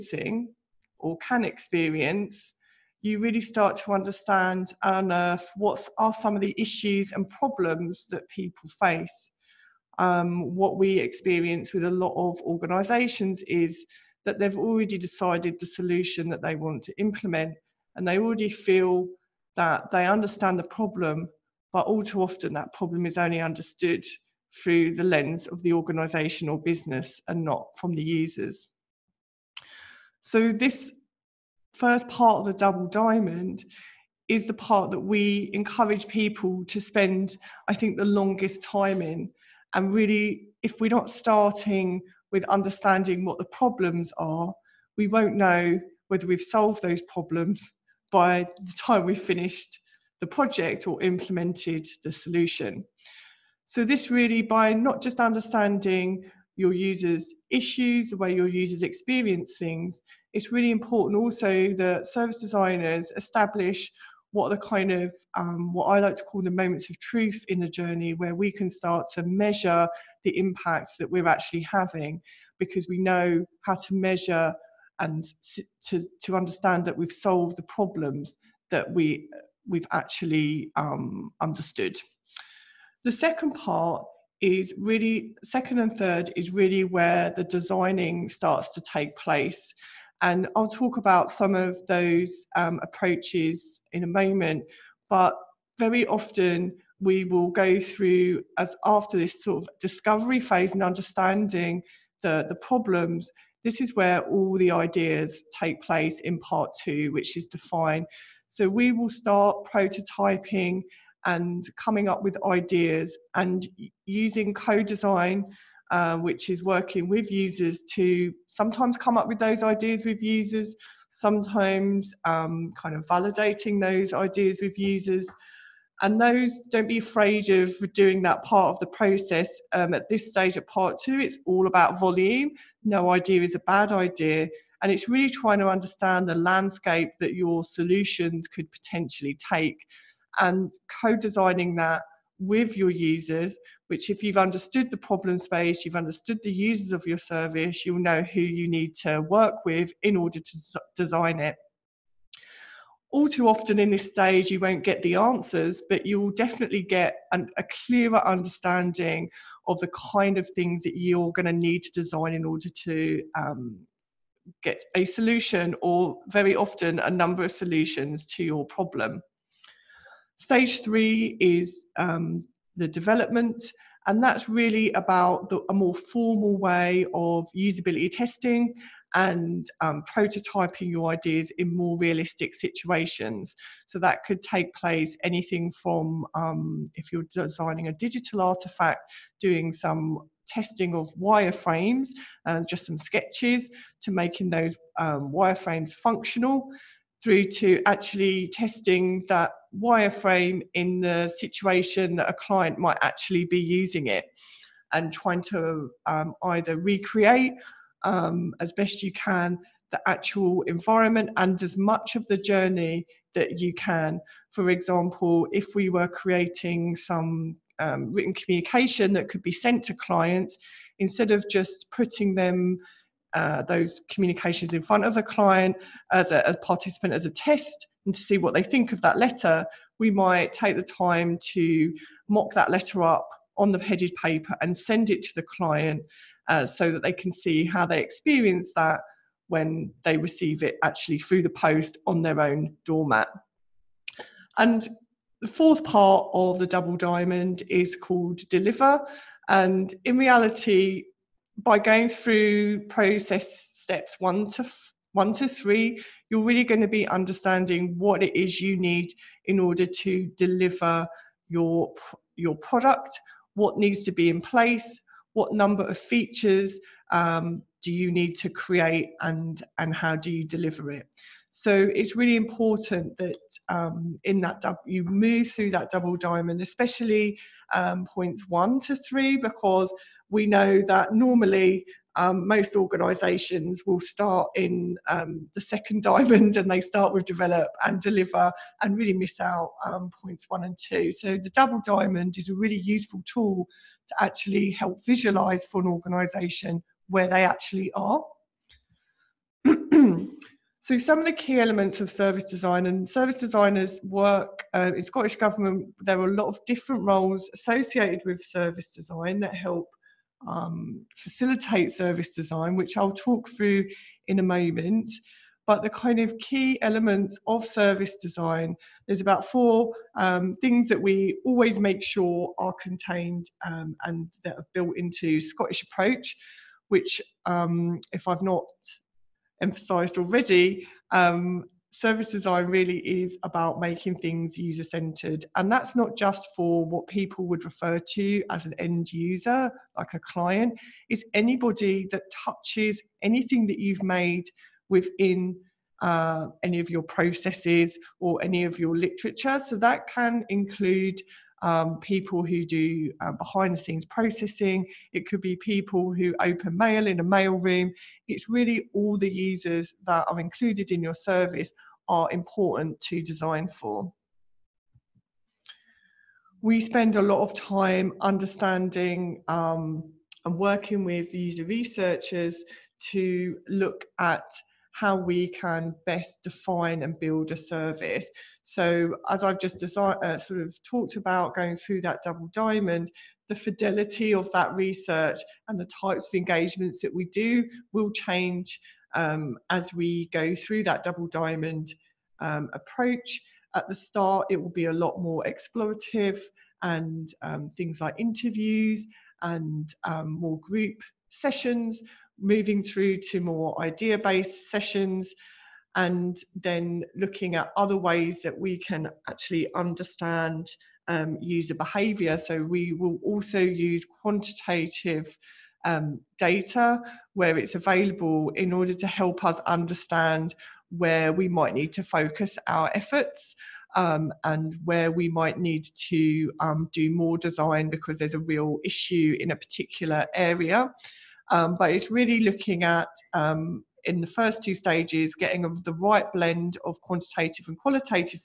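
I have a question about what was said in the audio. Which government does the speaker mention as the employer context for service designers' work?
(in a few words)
Scottish government.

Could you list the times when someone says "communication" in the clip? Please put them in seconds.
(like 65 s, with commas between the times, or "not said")
218 s, 224 s.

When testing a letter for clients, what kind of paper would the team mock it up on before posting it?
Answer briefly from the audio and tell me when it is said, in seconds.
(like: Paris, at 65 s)
headed paper, at 233 s.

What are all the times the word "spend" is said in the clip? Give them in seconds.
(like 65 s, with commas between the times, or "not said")
36 s, 366 s.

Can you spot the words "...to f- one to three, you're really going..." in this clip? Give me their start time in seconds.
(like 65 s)
254 s.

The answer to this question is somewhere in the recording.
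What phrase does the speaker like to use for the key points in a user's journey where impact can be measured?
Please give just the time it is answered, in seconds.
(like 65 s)
66 s.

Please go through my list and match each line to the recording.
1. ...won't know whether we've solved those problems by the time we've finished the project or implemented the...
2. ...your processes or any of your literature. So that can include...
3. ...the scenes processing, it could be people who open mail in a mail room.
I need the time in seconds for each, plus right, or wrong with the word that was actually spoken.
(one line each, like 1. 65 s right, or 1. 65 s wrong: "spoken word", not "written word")
1. 45 s right
2. 346 s right
3. 353 s right.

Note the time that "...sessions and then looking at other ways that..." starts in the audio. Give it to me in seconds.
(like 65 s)
404 s.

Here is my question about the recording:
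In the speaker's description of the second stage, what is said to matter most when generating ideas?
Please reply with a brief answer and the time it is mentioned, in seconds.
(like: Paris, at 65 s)
volume, at 132 s.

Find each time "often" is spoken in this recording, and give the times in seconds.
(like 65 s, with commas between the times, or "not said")
22 s, 96 s, 153 s, 166 s.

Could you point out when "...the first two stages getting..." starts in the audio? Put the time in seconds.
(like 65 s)
434 s.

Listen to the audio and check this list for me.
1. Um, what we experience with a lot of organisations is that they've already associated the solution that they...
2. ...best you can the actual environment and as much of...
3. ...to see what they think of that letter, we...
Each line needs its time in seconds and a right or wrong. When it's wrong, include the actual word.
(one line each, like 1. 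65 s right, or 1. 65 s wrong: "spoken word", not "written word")
1. 9 s wrong: "decided", not "associated"
2. 208 s right
3. 228 s right.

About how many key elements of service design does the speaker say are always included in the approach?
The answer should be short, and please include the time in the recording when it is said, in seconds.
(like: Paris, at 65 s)
4, at 319 s.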